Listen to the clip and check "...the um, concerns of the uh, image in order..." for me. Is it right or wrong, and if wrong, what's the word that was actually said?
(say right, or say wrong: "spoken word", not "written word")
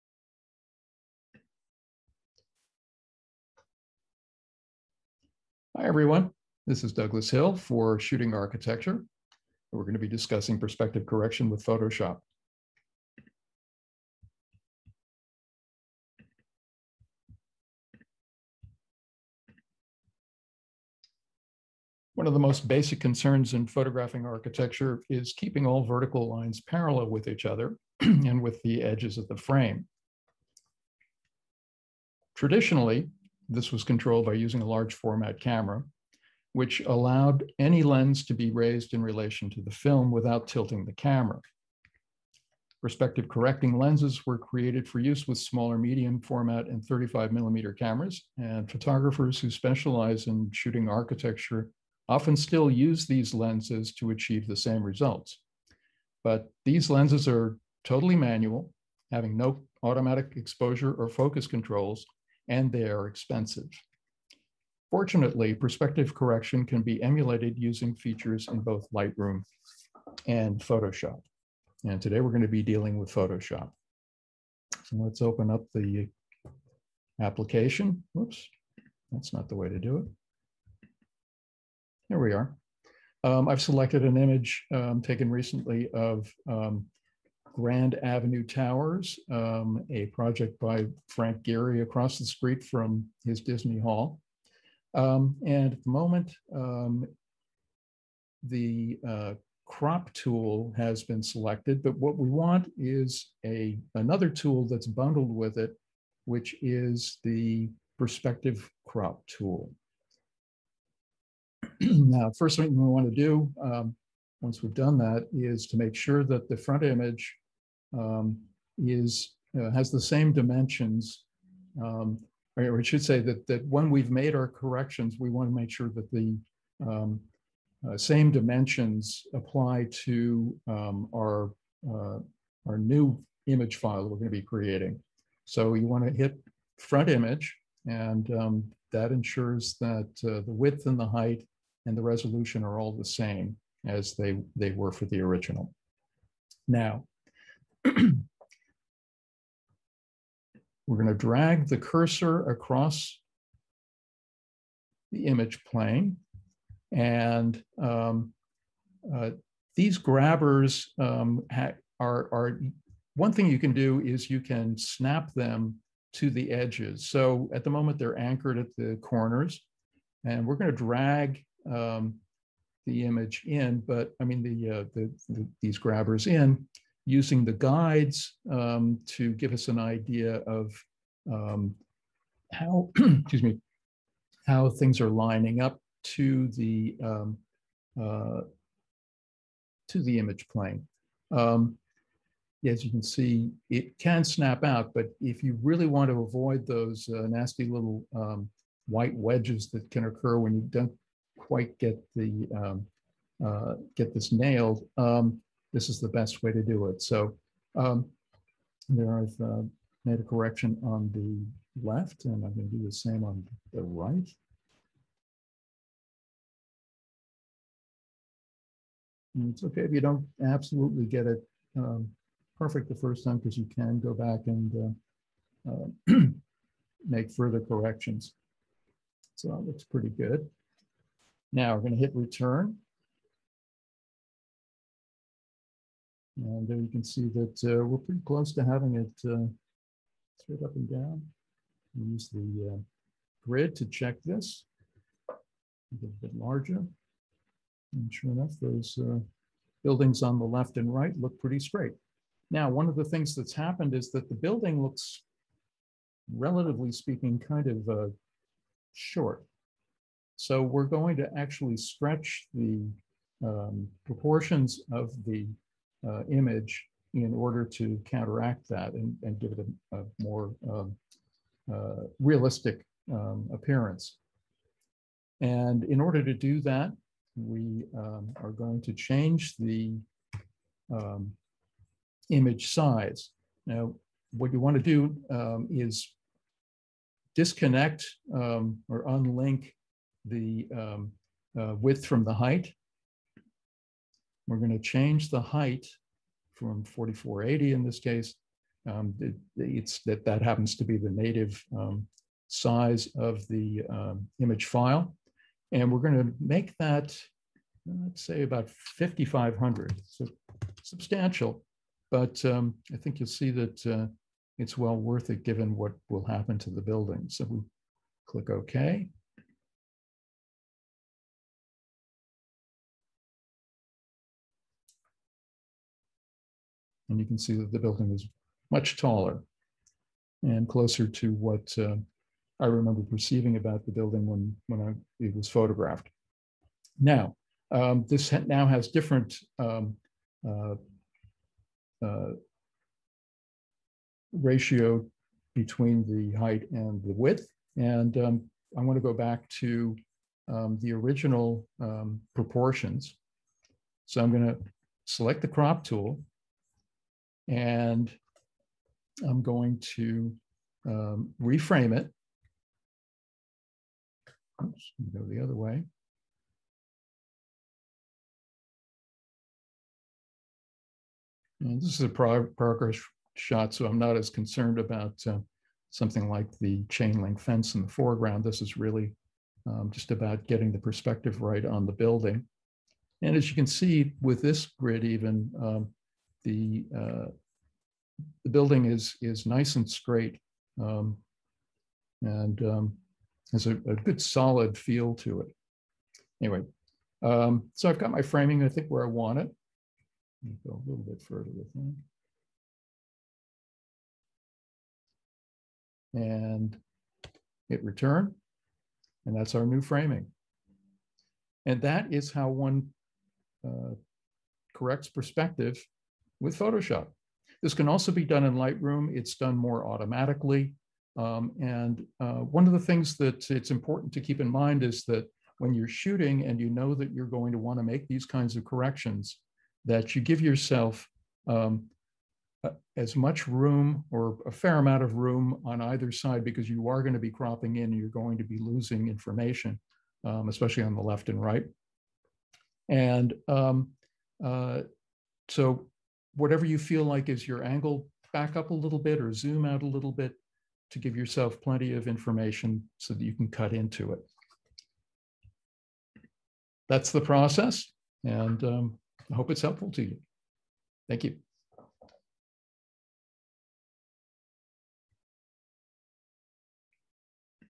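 wrong: "proportions", not "concerns".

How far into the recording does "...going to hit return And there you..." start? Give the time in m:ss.
3:51.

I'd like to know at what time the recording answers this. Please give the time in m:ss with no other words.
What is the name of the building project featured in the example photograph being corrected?
1:27.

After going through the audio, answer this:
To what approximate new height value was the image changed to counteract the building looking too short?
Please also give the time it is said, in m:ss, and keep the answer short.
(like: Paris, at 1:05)
5,500, at 5:08.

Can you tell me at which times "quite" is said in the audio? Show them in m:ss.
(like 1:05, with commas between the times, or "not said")
3:21.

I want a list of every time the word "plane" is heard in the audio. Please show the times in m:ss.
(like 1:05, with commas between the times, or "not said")
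2:35, 3:10.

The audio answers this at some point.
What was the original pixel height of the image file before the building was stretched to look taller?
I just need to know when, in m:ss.
4:56.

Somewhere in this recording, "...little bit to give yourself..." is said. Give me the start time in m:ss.
7:29.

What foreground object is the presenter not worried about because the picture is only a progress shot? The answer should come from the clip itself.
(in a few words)
chain link fence.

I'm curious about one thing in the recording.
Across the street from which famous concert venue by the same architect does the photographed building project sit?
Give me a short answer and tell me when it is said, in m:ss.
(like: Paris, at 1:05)
Disney Hall, at 1:33.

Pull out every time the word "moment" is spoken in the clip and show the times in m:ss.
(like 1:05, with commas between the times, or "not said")
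1:35, 2:47.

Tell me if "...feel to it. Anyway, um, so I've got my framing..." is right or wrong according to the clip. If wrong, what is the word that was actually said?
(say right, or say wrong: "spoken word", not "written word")
right.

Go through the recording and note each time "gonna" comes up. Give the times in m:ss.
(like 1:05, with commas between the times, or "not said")
2:50, 3:32.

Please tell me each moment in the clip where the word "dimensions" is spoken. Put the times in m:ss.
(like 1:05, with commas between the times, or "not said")
2:00, 2:08.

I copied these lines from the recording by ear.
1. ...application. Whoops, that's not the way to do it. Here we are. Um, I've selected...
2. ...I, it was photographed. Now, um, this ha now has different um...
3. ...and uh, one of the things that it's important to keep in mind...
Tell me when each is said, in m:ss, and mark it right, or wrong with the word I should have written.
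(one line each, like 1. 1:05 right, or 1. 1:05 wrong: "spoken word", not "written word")
1. 1:17 right
2. 5:34 right
3. 7:01 right.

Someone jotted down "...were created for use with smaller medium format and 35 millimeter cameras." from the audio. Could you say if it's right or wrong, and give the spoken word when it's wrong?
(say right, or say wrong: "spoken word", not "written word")
right.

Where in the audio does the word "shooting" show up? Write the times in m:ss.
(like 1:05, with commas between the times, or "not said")
0:07, 0:50, 7:05.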